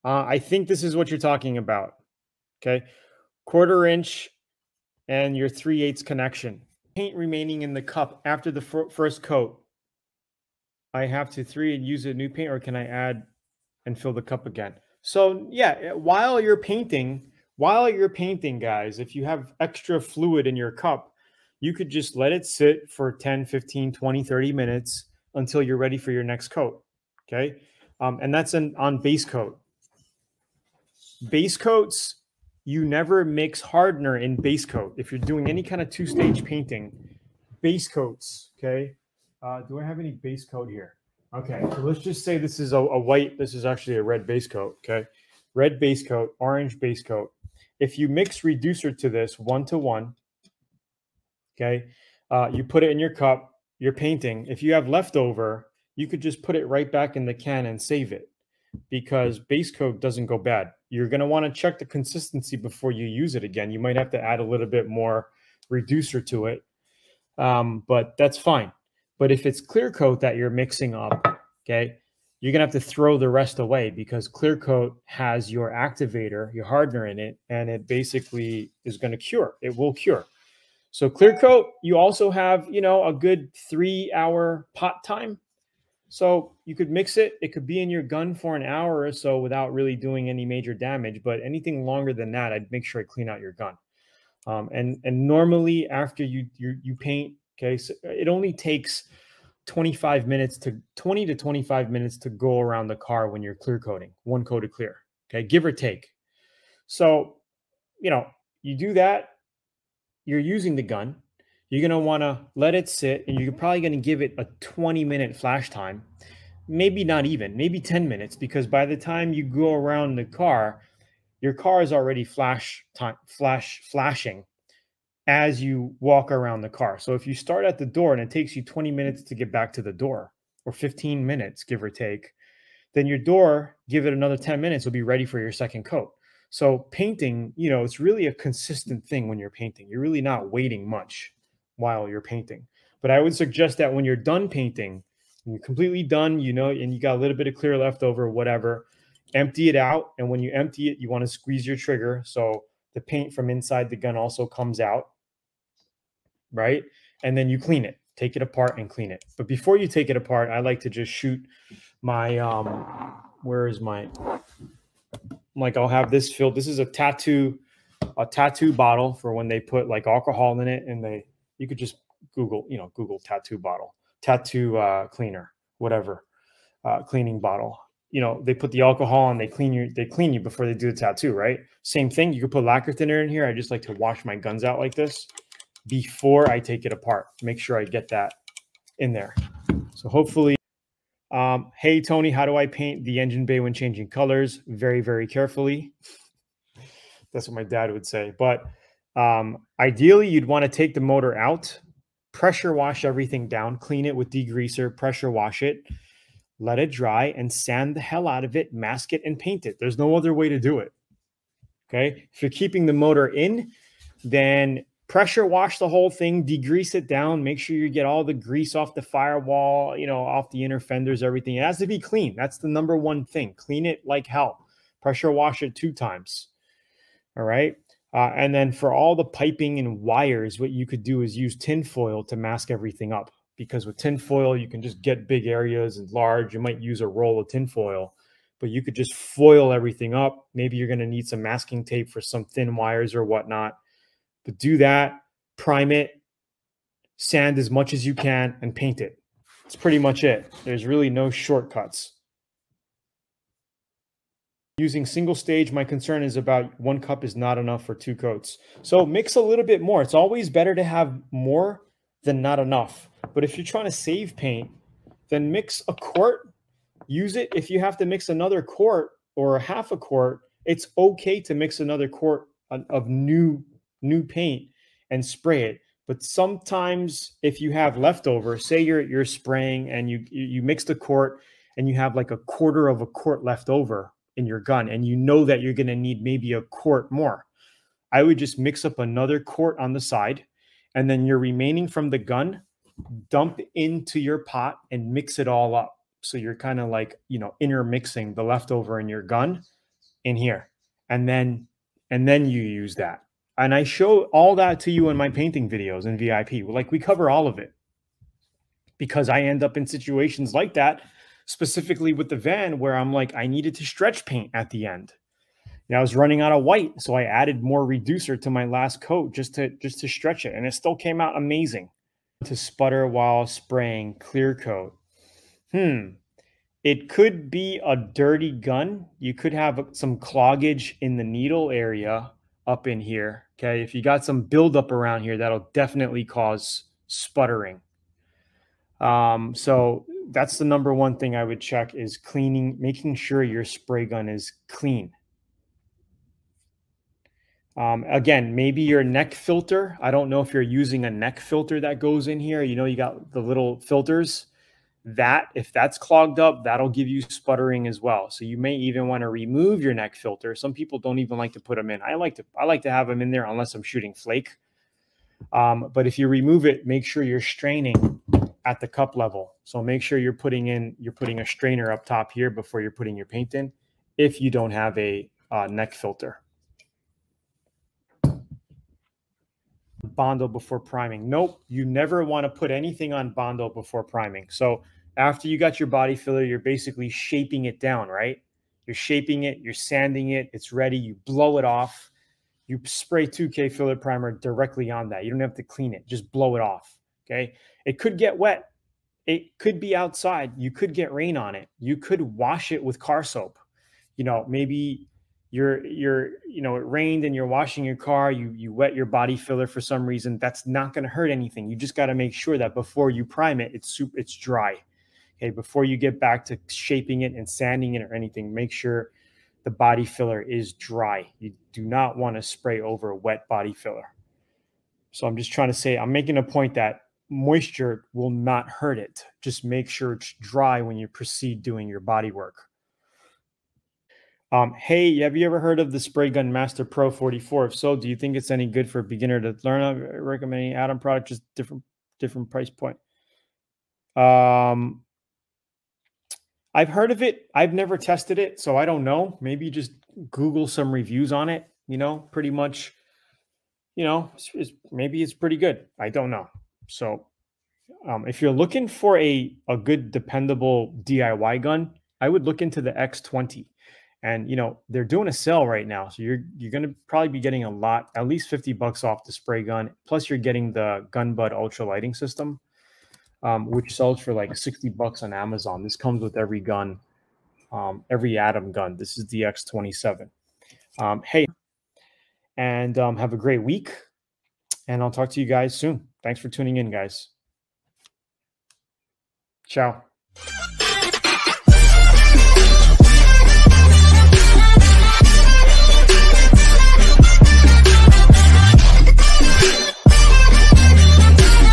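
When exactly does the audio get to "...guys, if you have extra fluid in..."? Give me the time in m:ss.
0:18.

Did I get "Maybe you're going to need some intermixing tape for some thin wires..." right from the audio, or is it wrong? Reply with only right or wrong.
wrong.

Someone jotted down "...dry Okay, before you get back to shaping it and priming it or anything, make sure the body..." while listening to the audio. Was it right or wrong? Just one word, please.
wrong.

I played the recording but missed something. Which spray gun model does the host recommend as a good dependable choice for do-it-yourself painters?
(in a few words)
X20.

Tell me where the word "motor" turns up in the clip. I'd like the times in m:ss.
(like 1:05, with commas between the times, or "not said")
3:21, 3:32.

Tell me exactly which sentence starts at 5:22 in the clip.
To sputter while spraying clear coat.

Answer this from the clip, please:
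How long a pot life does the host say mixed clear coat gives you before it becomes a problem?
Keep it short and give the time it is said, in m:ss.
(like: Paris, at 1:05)
3 hours, at 1:23.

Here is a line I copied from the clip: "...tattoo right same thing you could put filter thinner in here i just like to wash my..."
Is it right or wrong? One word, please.
wrong.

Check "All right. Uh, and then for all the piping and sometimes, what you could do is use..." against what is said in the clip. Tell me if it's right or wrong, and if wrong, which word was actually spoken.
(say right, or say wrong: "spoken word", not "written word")
wrong: "wires", not "sometimes".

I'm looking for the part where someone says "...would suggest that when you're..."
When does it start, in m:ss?
2:23.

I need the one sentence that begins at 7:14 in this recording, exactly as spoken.
Um, hey, have you ever heard of the Spray Gun Master Pro 44?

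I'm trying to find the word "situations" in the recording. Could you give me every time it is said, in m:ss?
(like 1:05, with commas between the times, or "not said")
5:09.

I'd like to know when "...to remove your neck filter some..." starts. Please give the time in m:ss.
5:59.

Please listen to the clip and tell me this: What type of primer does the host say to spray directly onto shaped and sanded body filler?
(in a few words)
2K filler primer.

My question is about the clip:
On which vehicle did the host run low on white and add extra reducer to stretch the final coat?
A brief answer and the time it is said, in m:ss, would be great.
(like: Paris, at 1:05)
The van, at 5:12.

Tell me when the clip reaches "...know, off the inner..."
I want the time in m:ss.
3:40.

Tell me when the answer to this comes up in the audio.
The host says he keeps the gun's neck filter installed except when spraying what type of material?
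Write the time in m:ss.
6:04.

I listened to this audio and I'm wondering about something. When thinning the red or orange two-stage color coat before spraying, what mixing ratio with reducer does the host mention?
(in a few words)
1 to 1.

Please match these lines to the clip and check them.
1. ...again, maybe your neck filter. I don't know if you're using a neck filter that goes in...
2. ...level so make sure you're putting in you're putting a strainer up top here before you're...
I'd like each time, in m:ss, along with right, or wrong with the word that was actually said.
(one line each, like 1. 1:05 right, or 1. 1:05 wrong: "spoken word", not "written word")
1. 5:48 right
2. 6:09 right.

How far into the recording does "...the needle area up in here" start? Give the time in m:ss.
5:31.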